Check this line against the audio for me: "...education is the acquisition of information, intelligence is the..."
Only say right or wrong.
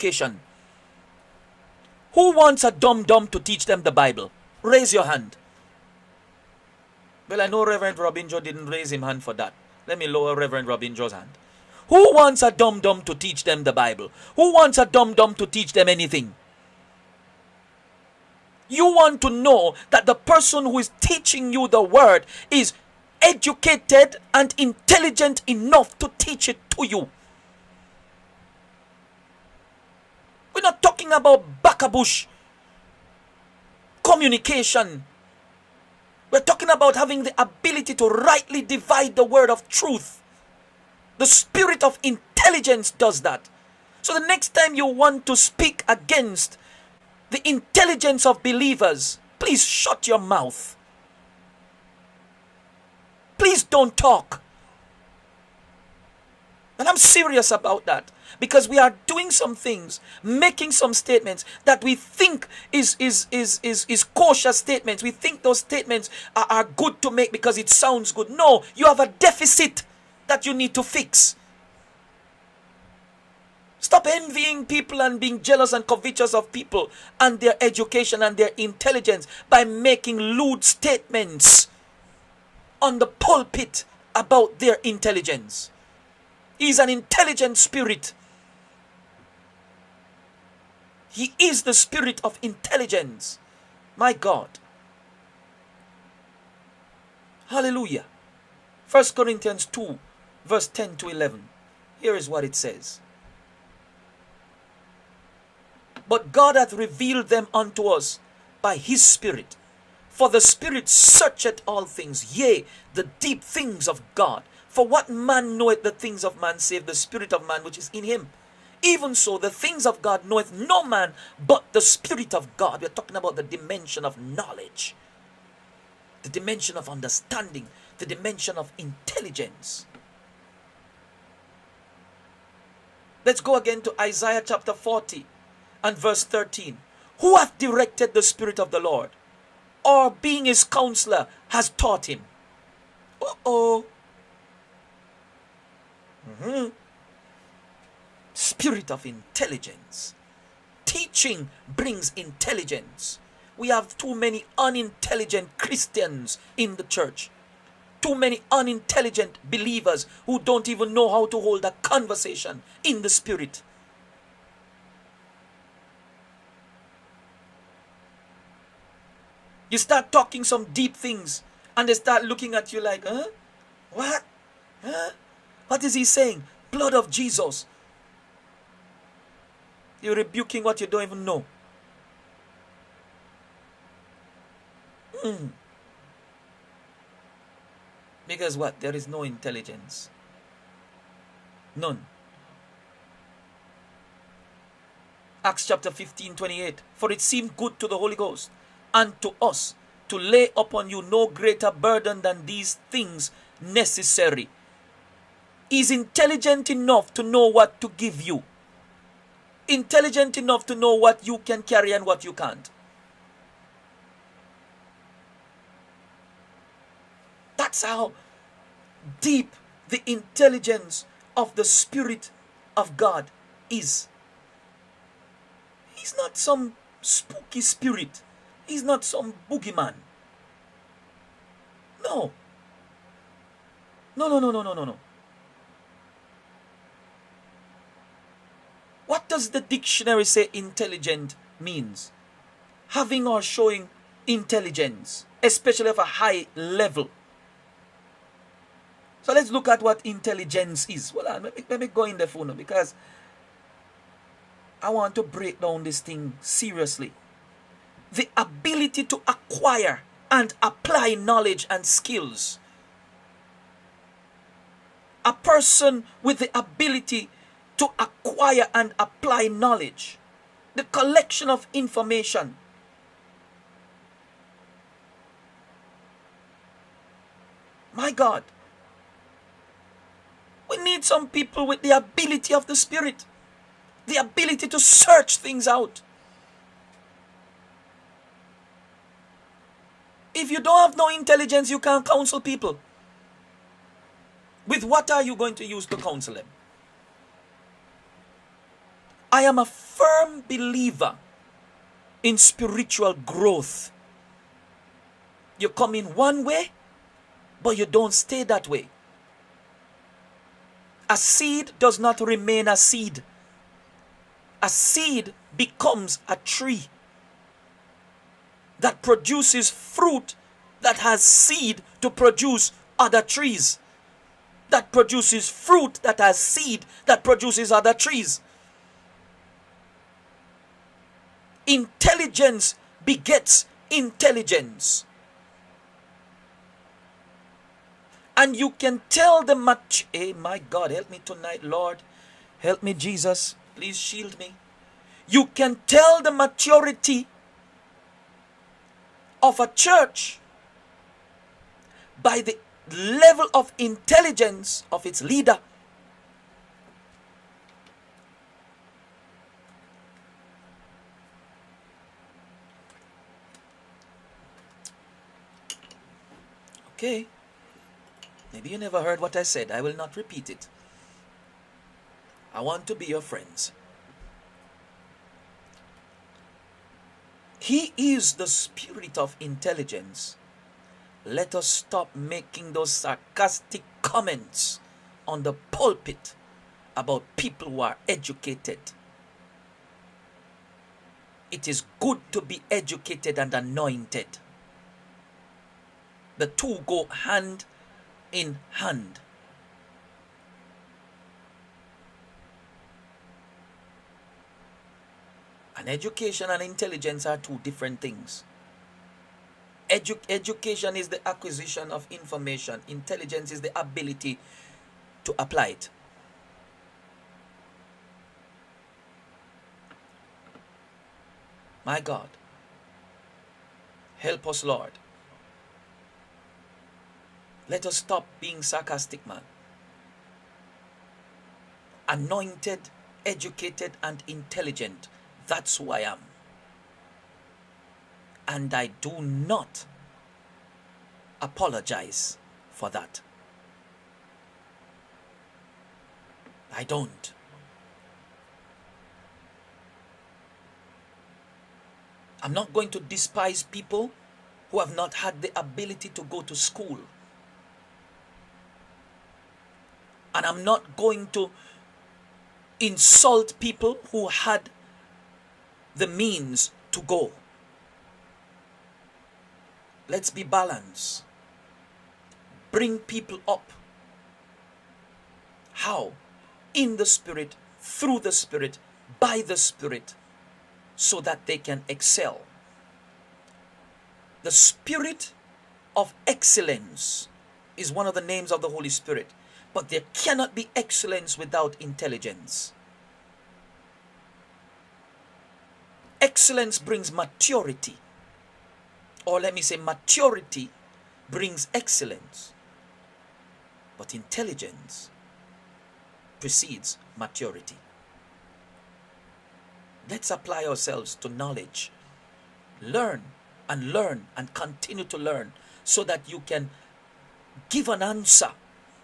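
right.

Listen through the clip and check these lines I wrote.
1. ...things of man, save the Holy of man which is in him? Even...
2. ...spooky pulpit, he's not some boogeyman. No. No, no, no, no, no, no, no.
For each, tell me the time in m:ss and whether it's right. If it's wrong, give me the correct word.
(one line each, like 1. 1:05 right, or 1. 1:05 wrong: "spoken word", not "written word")
1. 1:55 wrong: "Spirit", not "Holy"
2. 3:47 wrong: "spirit", not "pulpit".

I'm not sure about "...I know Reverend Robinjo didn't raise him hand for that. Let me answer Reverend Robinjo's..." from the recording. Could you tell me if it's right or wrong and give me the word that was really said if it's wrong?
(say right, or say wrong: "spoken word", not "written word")
wrong: "lower", not "answer".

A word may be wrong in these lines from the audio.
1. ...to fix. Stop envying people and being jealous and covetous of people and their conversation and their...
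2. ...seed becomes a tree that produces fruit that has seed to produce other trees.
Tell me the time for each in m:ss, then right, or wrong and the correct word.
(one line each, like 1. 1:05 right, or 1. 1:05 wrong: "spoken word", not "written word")
1. 1:10 wrong: "education", not "conversation"
2. 5:14 right.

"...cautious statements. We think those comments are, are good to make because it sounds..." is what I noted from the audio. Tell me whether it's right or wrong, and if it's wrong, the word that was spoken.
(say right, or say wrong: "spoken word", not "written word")
wrong: "statements", not "comments".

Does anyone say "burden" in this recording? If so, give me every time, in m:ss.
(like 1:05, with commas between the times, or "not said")
3:21.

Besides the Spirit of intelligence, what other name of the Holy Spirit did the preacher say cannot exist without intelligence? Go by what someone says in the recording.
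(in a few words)
Spirit of excellence.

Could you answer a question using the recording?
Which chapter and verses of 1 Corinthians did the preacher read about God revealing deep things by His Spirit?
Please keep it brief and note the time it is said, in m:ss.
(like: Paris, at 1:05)
2:10-11, at 1:38.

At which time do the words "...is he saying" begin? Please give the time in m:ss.
2:55.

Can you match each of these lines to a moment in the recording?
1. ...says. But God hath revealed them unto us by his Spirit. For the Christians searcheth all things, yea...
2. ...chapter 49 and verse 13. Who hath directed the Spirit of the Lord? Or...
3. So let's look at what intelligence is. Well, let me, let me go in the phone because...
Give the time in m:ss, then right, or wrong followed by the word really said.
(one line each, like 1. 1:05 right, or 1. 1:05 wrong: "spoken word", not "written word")
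1. 1:42 wrong: "Spirit", not "Christians"
2. 2:14 wrong: "40", not "49"
3. 4:09 right.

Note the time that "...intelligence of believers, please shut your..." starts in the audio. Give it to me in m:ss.
0:47.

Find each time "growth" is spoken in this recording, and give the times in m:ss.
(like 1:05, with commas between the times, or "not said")
5:03.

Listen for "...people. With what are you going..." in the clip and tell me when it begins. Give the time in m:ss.
4:52.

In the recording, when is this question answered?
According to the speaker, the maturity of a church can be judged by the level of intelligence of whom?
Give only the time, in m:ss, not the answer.
5:55.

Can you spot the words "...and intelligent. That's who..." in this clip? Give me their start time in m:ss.
7:14.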